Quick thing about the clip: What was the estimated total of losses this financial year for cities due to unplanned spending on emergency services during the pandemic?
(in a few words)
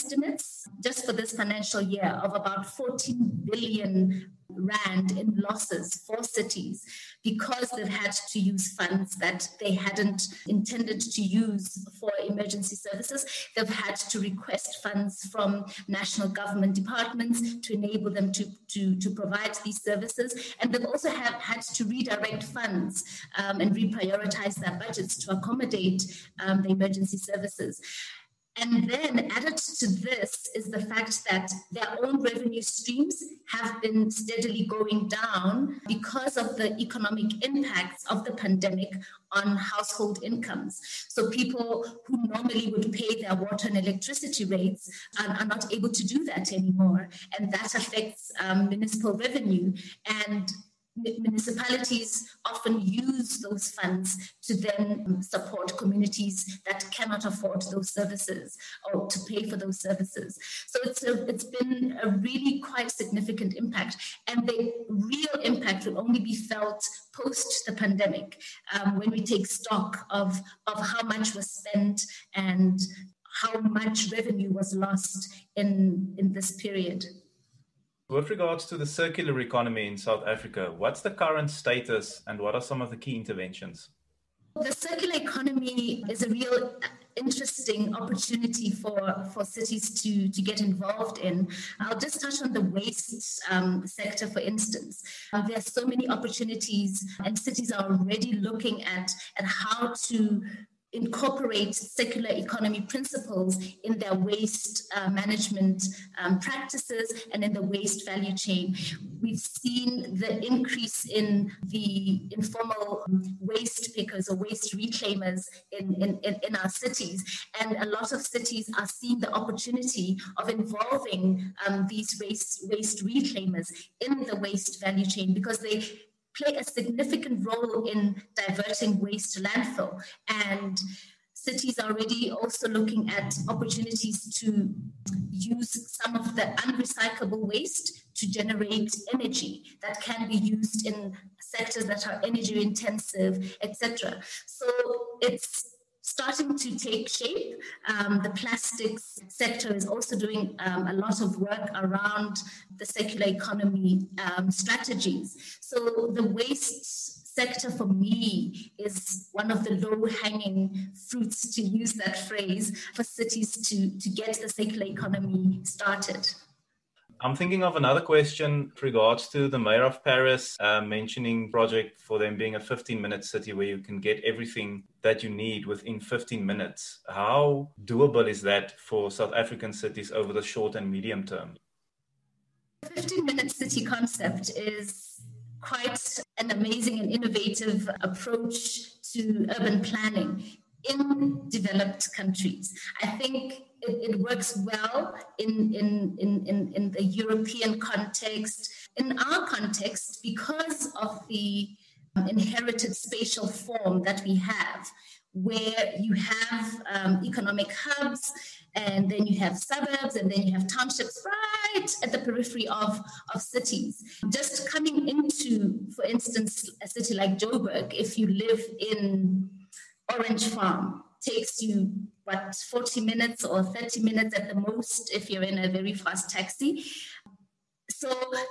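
14 billion rand.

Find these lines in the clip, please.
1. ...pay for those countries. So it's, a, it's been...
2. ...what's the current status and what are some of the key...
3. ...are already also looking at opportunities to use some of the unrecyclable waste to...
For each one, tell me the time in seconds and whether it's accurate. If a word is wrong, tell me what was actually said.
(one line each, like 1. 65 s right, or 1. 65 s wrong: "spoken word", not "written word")
1. 59 s wrong: "services", not "countries"
2. 80 s right
3. 131 s right.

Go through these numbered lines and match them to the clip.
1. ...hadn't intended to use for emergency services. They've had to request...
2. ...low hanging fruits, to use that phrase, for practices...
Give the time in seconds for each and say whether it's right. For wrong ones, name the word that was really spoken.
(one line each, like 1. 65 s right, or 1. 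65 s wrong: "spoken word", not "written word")
1. 9 s right
2. 159 s wrong: "cities", not "practices".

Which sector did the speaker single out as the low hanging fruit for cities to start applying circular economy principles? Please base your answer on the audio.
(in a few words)
waste sector.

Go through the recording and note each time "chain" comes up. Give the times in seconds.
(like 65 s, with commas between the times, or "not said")
108 s, 125 s.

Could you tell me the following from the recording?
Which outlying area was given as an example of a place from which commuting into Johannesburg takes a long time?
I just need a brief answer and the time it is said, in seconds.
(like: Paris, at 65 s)
Orange Farm, at 220 s.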